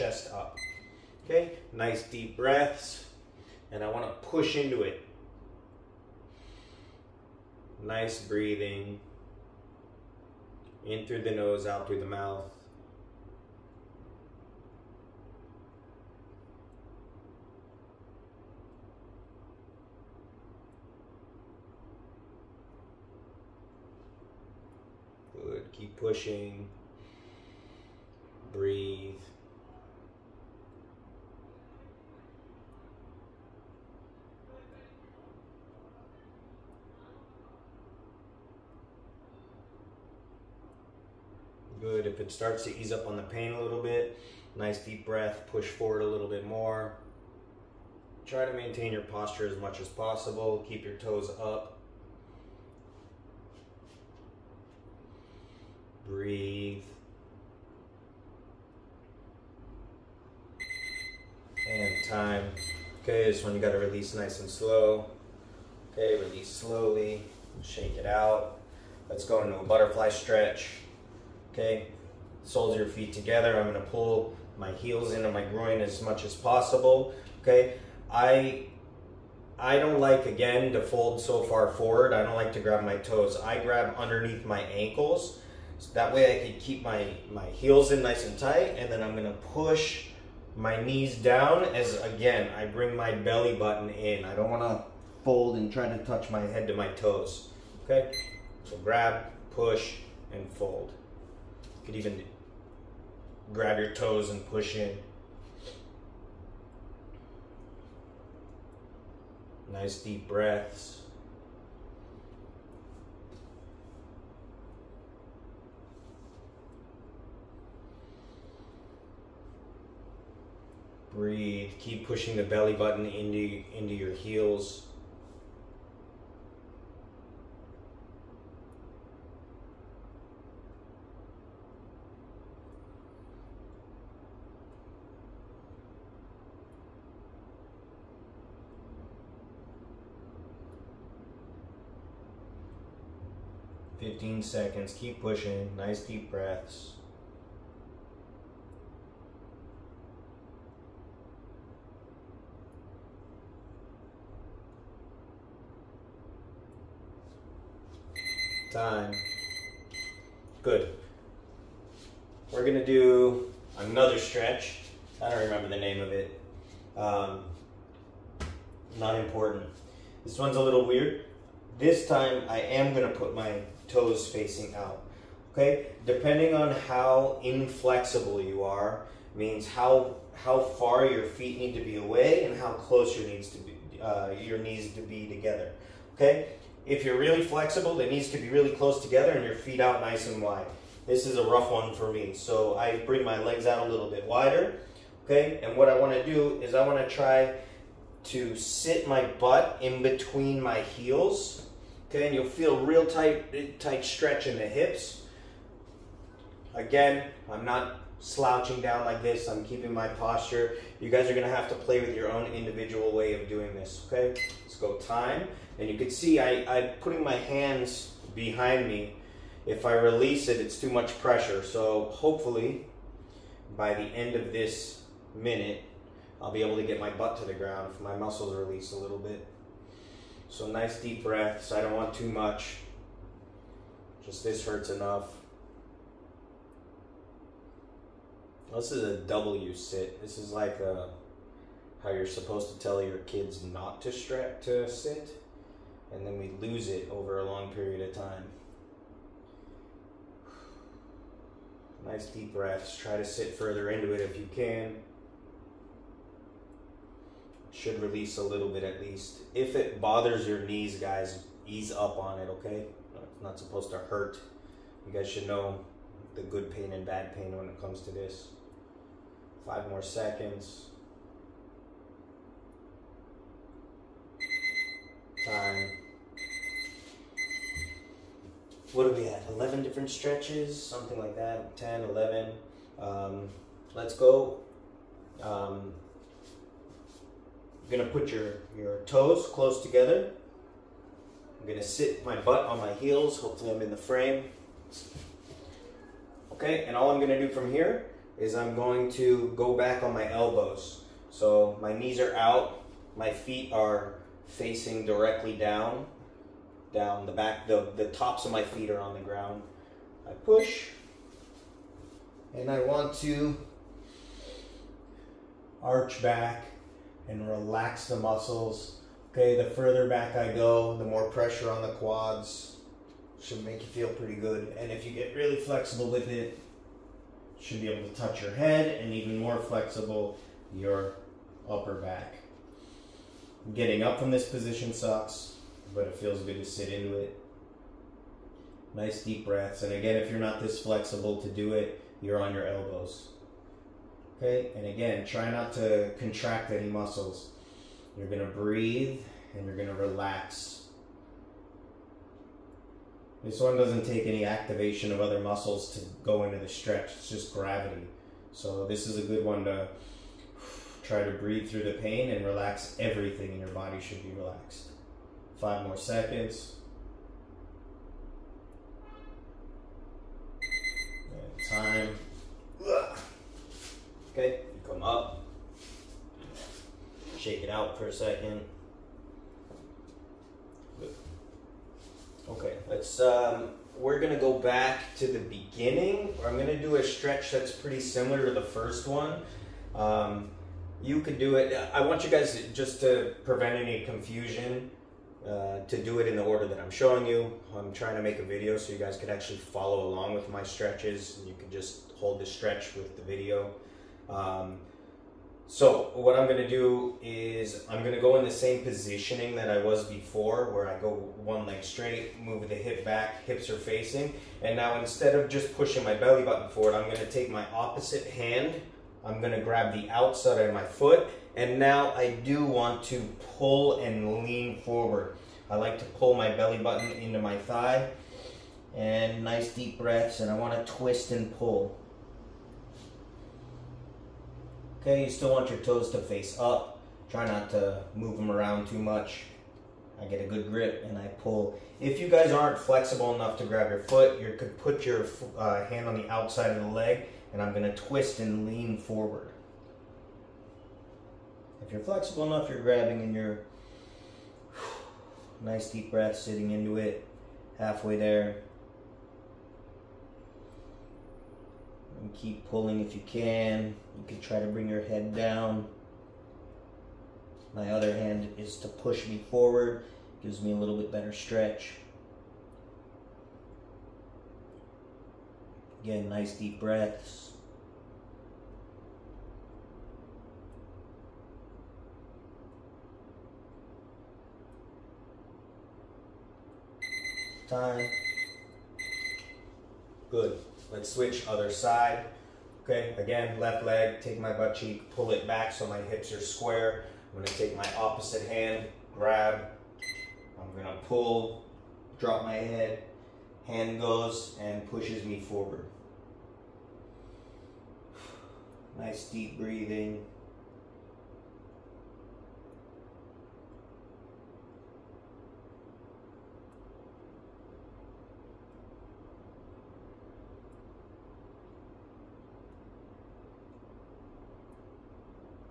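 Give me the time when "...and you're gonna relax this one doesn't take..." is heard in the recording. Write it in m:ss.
5:49.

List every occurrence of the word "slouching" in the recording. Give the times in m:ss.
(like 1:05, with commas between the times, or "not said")
3:28.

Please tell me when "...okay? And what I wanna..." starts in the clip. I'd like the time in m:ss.
3:15.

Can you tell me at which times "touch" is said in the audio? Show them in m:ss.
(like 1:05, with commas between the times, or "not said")
1:36, 5:28.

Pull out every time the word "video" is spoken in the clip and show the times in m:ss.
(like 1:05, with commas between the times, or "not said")
6:38, 6:43.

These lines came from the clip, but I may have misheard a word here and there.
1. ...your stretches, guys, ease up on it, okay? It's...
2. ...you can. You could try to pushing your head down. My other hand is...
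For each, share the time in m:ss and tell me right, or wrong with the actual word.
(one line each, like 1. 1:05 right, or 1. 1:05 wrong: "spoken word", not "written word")
1. 4:20 wrong: "knees", not "stretches"
2. 7:43 wrong: "bring", not "pushing".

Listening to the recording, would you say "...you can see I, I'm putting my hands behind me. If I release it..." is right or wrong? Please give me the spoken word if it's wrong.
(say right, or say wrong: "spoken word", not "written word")
right.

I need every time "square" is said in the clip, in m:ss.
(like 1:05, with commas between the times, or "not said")
8:16.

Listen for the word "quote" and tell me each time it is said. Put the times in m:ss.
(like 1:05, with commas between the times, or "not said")
not said.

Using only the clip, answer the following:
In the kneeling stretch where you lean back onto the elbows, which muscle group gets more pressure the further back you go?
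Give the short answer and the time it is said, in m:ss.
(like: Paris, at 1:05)
quads, at 5:21.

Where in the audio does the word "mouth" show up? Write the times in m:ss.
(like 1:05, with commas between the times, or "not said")
0:12.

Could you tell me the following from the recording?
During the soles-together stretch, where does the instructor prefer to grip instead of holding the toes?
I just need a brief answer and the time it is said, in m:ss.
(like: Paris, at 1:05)
underneath my ankles, at 1:23.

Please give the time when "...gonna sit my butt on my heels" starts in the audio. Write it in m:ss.
4:51.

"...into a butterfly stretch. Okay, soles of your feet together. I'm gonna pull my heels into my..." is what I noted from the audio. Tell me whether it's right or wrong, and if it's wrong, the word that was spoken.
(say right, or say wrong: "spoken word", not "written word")
right.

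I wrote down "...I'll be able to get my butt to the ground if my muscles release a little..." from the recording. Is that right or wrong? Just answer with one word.
right.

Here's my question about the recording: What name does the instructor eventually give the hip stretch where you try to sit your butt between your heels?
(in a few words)
W sit.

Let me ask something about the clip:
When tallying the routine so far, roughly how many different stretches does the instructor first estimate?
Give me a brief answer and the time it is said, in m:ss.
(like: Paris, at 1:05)
11, at 4:39.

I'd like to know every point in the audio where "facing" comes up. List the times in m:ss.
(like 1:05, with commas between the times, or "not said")
2:54, 5:04, 6:53.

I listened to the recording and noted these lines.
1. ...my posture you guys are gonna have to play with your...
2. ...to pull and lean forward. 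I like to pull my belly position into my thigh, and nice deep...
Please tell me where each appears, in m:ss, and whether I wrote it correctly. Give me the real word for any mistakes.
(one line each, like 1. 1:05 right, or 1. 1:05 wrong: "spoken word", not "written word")
1. 3:29 right
2. 7:03 wrong: "button", not "position".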